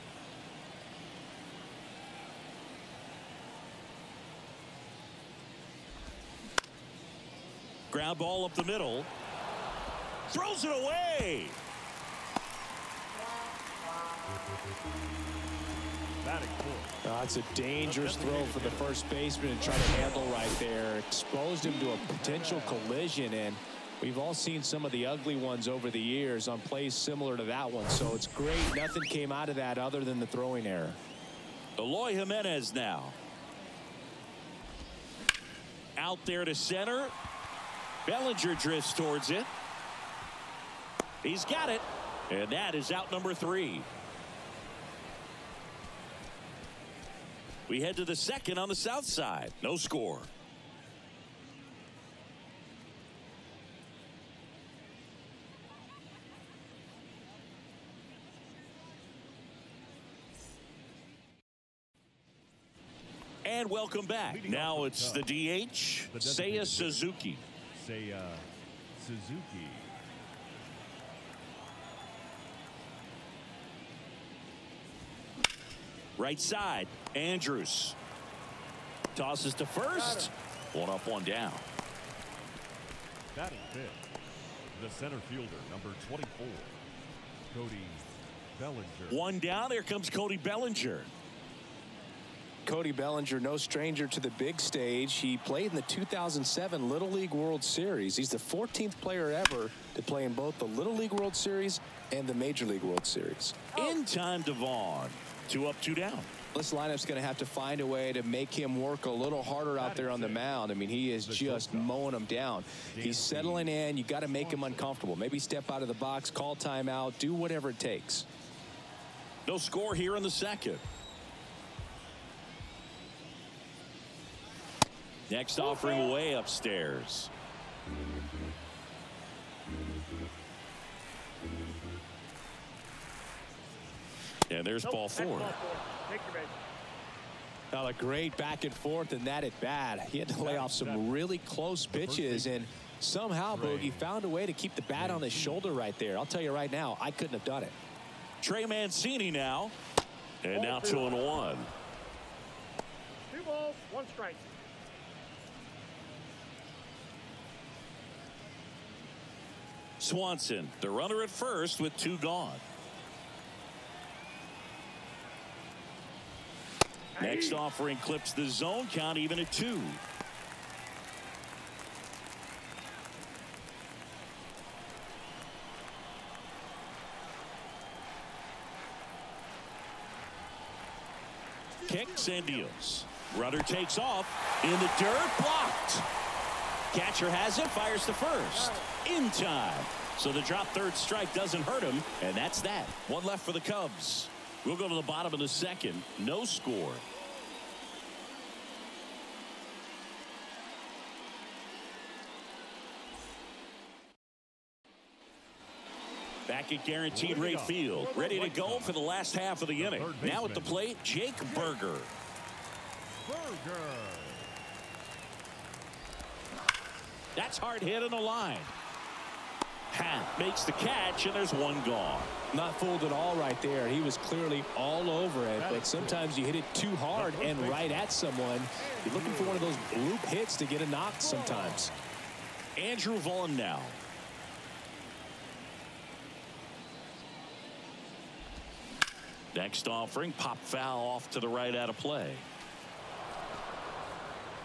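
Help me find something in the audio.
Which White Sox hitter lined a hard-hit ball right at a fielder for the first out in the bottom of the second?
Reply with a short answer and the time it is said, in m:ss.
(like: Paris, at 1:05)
Jake Burger, at 3:31.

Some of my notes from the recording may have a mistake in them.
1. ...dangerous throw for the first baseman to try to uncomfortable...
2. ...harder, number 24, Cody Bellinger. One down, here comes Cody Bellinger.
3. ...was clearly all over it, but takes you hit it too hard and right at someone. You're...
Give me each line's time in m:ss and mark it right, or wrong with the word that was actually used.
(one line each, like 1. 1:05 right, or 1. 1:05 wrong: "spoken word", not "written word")
1. 0:17 wrong: "handle", not "uncomfortable"
2. 1:25 wrong: "fielder", not "harder"
3. 3:43 wrong: "sometimes", not "takes".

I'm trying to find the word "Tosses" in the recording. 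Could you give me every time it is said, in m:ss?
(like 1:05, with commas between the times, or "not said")
1:19.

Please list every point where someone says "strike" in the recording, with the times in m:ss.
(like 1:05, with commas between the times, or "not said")
2:34, 3:10.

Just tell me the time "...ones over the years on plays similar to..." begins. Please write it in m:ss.
0:25.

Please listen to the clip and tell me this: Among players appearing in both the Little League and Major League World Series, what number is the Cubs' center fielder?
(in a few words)
14th.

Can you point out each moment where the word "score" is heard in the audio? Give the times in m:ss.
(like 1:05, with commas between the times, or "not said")
0:49, 1:59, 3:16.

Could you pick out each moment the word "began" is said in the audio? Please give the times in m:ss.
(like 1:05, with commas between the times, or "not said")
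not said.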